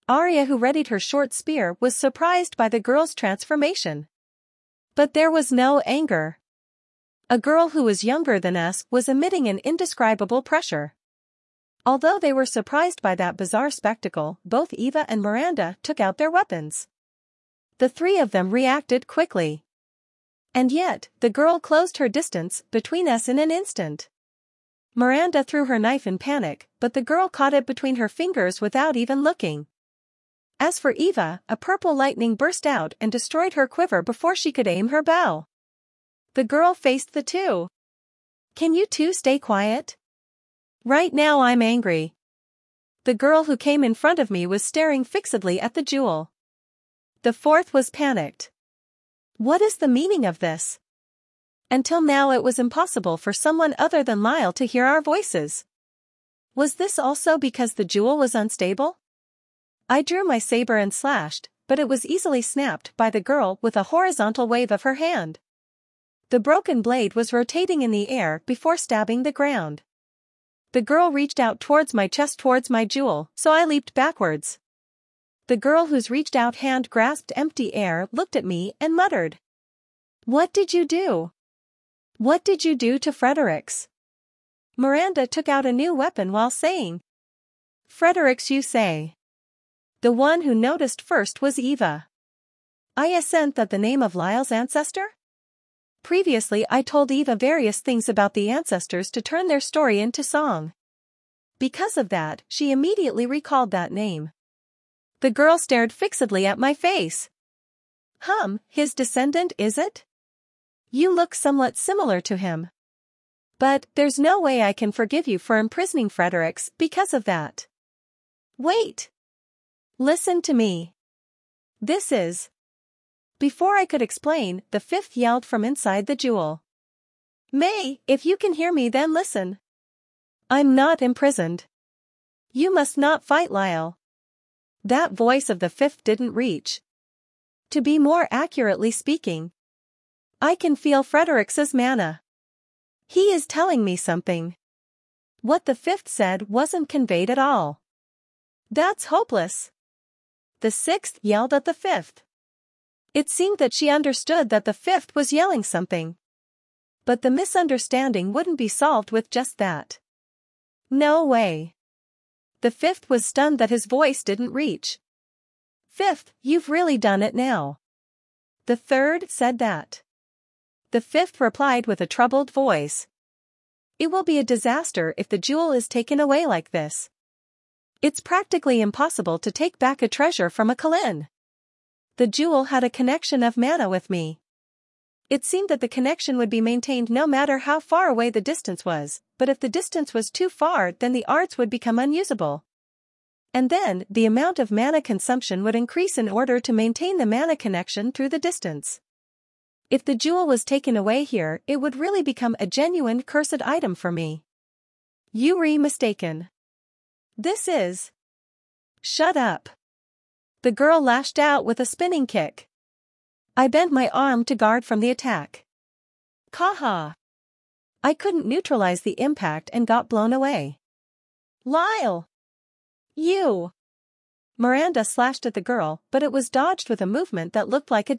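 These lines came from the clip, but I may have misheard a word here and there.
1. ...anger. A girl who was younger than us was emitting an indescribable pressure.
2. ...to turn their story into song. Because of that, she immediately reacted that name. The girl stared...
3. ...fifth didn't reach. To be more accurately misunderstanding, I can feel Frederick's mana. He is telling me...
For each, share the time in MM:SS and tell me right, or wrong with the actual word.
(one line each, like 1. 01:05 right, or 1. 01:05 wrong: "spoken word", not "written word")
1. 00:05 right
2. 01:39 wrong: "recalled", not "reacted"
3. 02:15 wrong: "speaking", not "misunderstanding".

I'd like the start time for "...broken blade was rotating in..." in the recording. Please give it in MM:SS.
01:06.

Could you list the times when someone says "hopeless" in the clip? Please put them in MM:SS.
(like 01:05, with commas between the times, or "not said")
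02:29.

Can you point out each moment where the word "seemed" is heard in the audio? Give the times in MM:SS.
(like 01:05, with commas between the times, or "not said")
02:33, 03:05.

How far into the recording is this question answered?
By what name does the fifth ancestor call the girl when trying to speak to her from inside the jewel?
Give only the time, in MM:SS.
02:07.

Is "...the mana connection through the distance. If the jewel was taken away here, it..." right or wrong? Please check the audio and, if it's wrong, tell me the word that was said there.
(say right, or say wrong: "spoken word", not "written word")
right.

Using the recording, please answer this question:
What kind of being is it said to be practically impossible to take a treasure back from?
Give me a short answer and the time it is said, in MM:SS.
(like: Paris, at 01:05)
a Qilin, at 03:00.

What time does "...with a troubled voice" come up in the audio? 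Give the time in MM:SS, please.
02:51.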